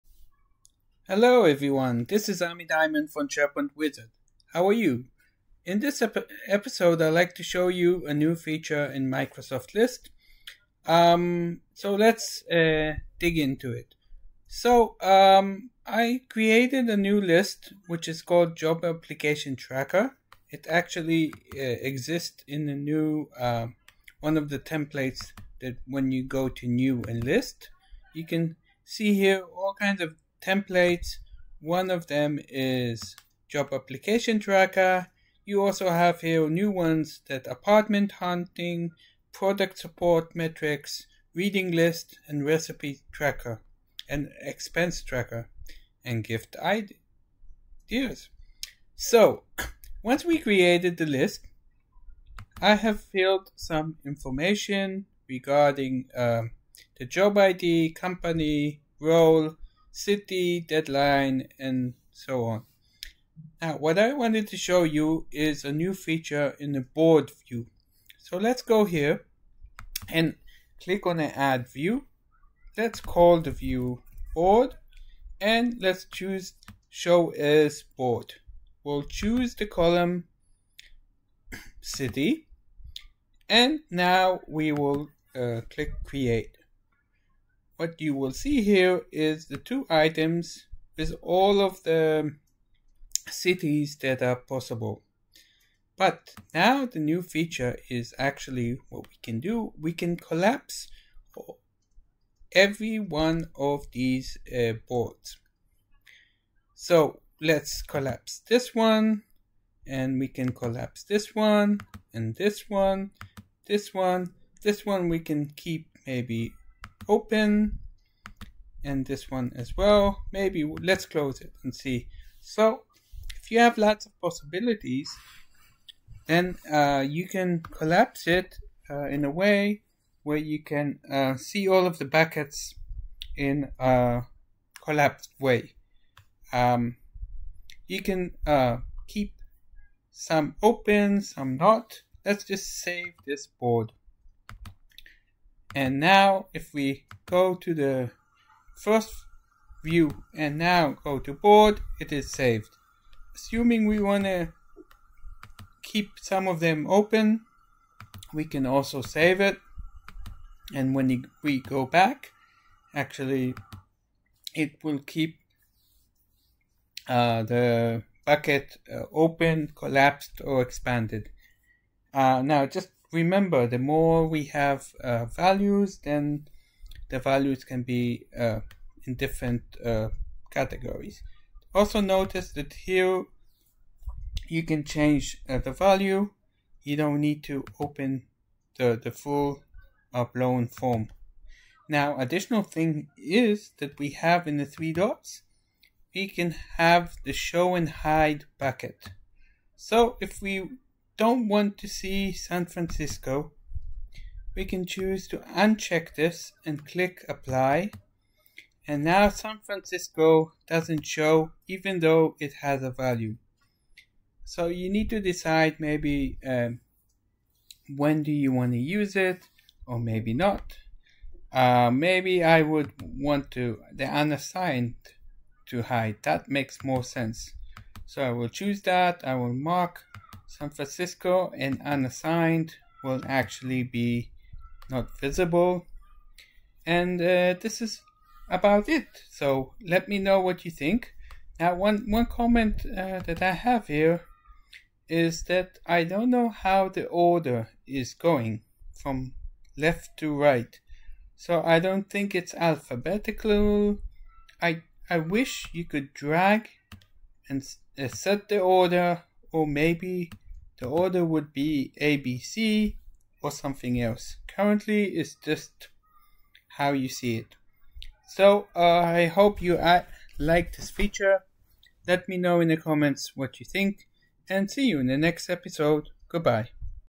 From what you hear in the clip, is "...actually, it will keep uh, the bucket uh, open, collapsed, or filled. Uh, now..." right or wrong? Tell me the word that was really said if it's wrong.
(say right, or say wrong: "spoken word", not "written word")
wrong: "expanded", not "filled".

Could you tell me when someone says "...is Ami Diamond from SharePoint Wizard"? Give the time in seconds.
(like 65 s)
2 s.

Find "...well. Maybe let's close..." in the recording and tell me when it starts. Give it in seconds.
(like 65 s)
119 s.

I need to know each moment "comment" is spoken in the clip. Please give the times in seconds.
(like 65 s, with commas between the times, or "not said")
242 s, 272 s.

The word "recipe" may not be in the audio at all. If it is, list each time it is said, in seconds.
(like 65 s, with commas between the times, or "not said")
42 s.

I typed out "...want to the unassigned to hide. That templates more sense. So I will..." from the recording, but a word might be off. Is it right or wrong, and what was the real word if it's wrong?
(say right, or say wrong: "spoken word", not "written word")
wrong: "makes", not "templates".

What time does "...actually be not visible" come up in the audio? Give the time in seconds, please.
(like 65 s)
233 s.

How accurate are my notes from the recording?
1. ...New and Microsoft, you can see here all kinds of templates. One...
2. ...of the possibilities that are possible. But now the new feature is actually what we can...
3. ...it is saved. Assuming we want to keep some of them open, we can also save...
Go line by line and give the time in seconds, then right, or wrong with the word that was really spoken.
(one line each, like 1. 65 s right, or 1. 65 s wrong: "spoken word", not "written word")
1. 26 s wrong: "List", not "Microsoft"
2. 91 s wrong: "cities", not "possibilities"
3. 151 s right.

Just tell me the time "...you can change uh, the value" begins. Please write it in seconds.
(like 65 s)
184 s.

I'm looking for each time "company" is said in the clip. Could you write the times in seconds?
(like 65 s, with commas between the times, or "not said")
57 s.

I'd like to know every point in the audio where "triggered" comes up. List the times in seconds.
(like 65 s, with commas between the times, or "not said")
not said.